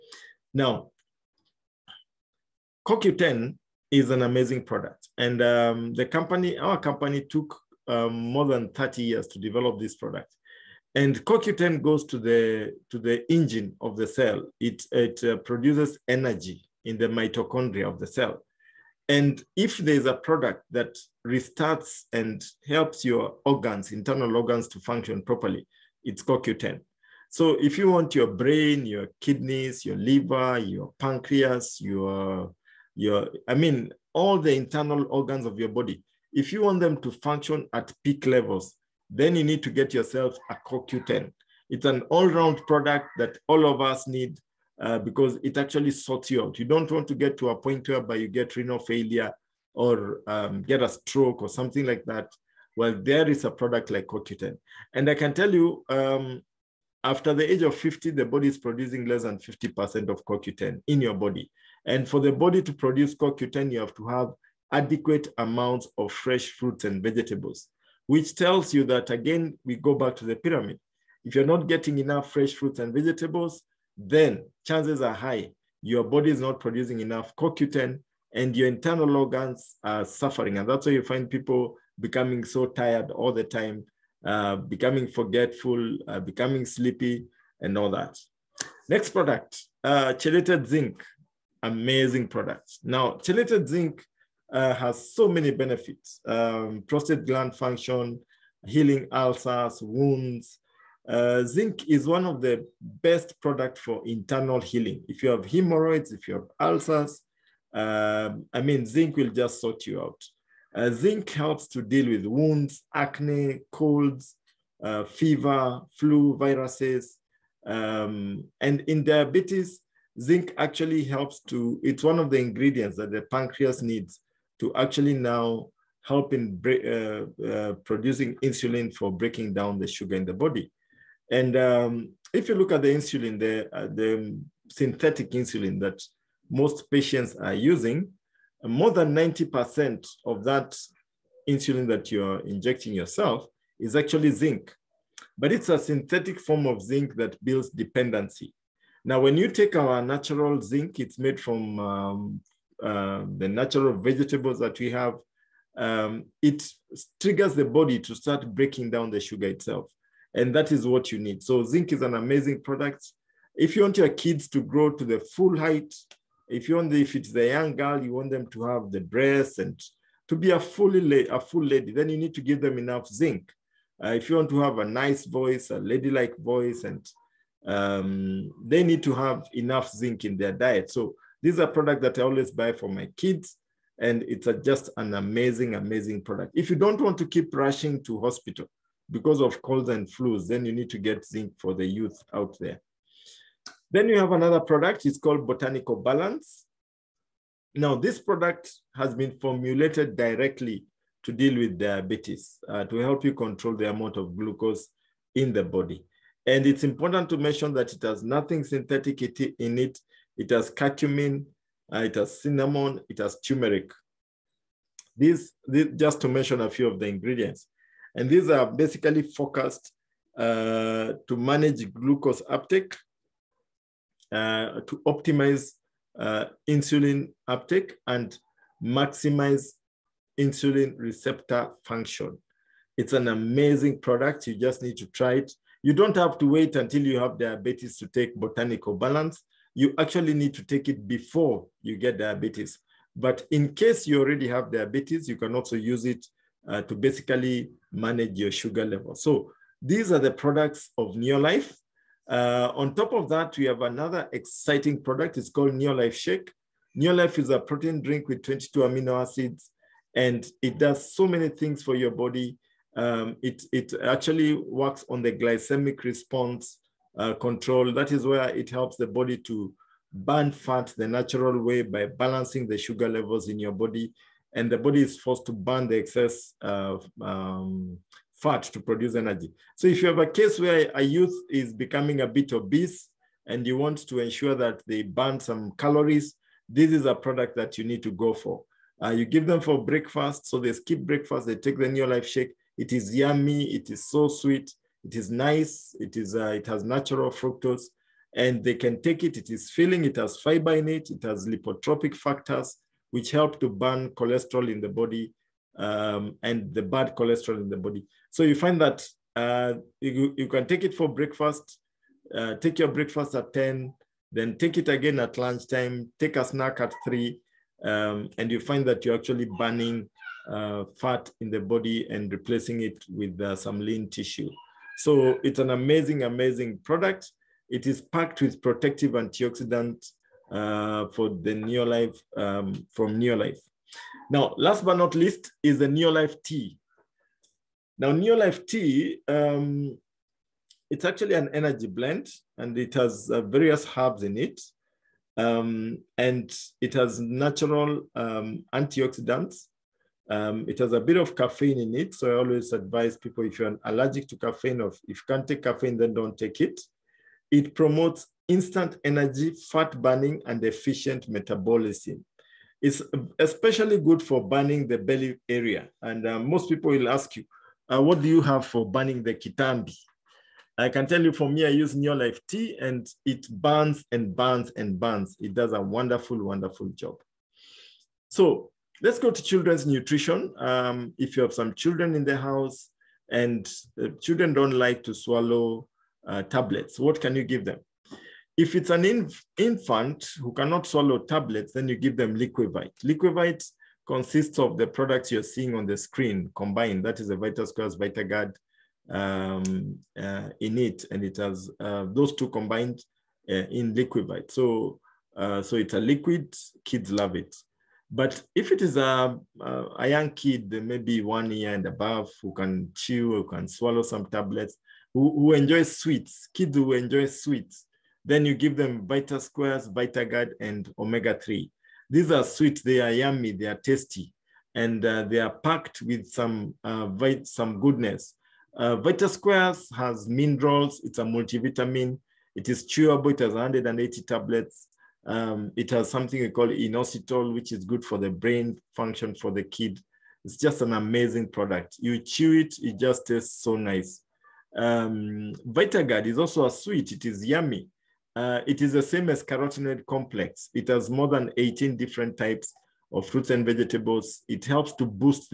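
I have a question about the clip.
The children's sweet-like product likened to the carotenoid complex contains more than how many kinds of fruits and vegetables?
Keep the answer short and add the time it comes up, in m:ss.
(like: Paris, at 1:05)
18, at 7:31.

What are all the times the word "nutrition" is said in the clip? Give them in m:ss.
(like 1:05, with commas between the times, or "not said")
6:19.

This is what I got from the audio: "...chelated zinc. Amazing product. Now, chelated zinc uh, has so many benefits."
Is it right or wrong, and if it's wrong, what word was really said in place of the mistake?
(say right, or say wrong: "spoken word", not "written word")
right.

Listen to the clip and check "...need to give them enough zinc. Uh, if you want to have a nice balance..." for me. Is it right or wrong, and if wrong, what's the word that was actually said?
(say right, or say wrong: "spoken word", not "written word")
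wrong: "voice", not "balance".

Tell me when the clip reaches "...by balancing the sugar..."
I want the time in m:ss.
4:31.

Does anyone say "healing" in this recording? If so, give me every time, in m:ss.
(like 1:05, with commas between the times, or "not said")
1:38, 1:44.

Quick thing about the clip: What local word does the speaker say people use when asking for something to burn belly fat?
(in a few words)
kitambi.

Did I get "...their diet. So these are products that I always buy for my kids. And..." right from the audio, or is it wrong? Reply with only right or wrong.
right.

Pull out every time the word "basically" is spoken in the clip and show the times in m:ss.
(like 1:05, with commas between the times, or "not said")
3:38, 4:06.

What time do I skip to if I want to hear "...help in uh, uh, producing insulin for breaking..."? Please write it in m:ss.
2:06.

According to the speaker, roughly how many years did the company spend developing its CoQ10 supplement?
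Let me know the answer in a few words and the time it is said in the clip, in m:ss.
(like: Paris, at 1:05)
30 years, at 0:08.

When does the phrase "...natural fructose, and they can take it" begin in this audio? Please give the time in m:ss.
4:56.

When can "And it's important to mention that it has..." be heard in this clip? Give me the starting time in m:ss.
3:26.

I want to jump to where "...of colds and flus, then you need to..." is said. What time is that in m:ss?
3:09.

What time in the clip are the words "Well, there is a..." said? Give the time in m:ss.
0:52.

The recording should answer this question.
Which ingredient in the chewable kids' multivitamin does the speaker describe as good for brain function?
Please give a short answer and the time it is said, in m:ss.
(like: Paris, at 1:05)
inositol, at 7:16.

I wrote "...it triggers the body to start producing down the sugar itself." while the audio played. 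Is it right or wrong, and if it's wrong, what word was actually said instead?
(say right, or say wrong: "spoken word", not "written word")
wrong: "breaking", not "producing".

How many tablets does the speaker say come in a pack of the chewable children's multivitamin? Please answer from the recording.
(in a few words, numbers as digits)
180.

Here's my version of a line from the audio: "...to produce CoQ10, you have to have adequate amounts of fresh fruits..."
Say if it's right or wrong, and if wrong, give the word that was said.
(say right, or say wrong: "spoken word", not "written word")
right.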